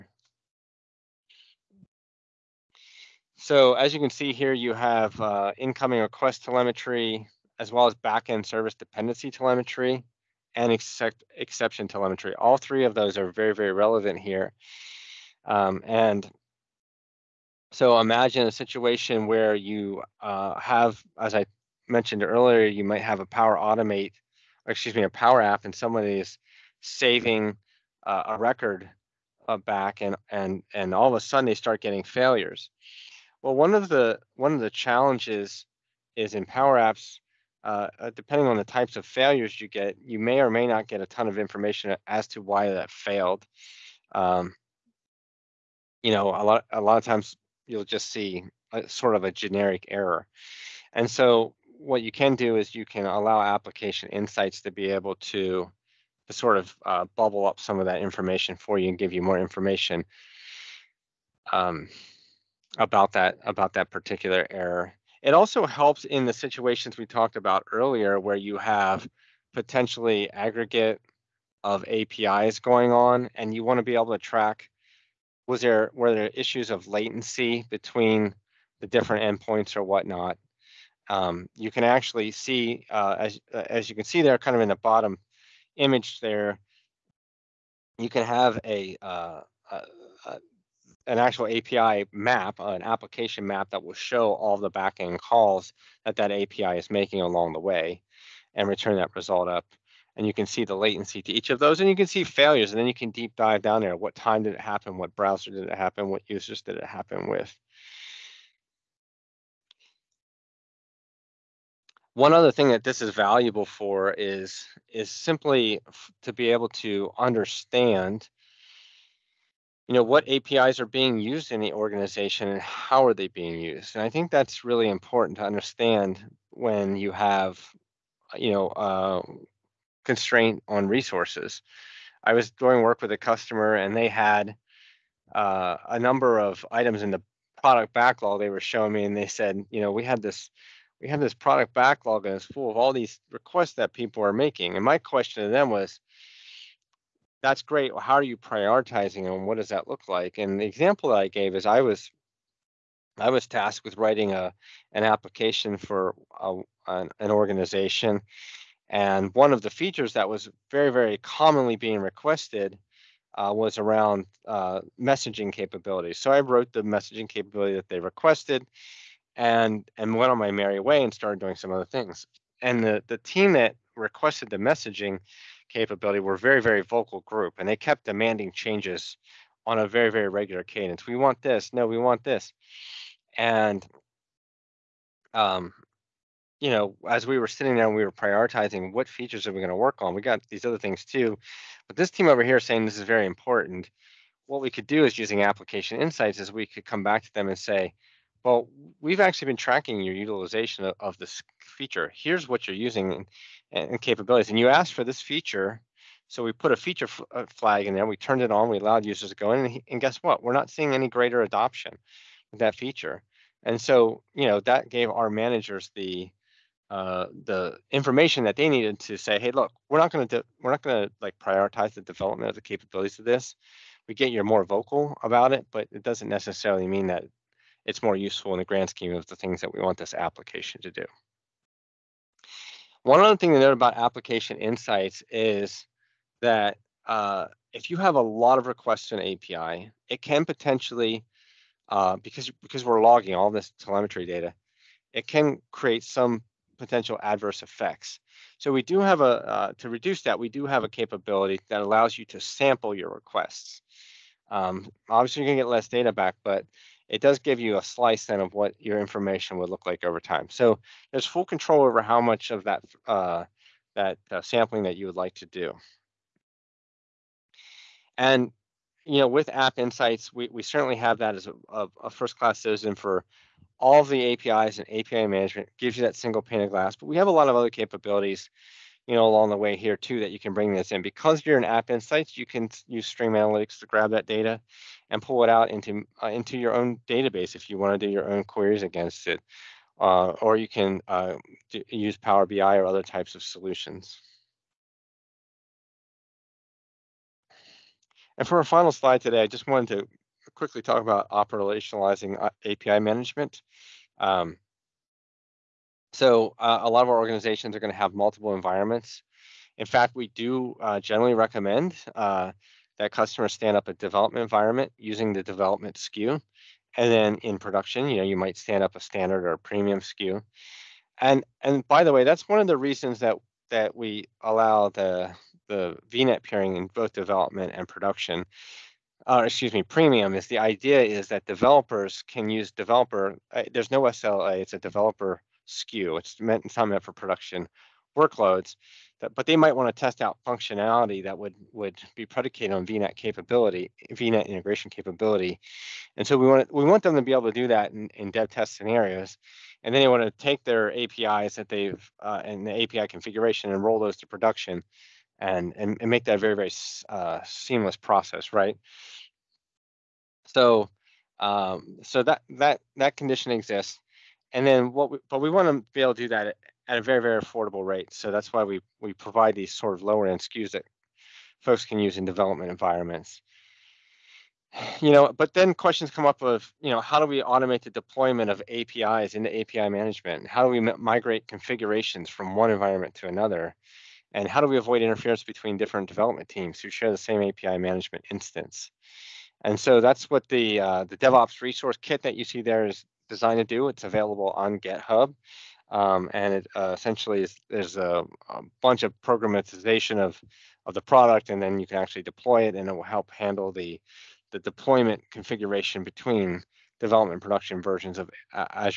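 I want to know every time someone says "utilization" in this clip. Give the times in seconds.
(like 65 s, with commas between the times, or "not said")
200 s.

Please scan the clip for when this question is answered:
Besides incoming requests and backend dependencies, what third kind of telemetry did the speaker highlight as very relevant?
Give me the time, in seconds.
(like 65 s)
11 s.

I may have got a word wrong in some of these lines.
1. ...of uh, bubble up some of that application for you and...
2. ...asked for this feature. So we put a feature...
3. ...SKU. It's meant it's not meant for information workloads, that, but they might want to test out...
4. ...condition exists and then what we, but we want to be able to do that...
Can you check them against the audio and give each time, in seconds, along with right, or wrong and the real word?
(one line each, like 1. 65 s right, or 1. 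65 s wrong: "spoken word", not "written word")
1. 56 s wrong: "information", not "application"
2. 204 s right
3. 335 s wrong: "production", not "information"
4. 363 s right.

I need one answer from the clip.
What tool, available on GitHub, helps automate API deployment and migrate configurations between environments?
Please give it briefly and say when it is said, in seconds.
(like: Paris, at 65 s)
DevOps resource kit, at 391 s.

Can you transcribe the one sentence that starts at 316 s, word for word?
And then in production, you know, you might stand up a standard or a premium SKU.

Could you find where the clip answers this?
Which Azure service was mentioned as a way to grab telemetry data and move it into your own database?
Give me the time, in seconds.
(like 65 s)
283 s.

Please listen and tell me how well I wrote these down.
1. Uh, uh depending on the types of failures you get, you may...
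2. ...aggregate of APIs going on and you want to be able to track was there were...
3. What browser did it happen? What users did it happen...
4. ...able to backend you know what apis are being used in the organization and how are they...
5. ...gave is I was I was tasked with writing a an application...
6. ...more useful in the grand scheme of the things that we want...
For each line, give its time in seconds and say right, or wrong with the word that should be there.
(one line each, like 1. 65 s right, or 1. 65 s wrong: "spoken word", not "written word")
1. 37 s right
2. 70 s right
3. 104 s right
4. 116 s wrong: "understand", not "backend"
5. 151 s right
6. 228 s right.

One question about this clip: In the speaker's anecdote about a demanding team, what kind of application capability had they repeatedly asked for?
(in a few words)
Messaging capabilities.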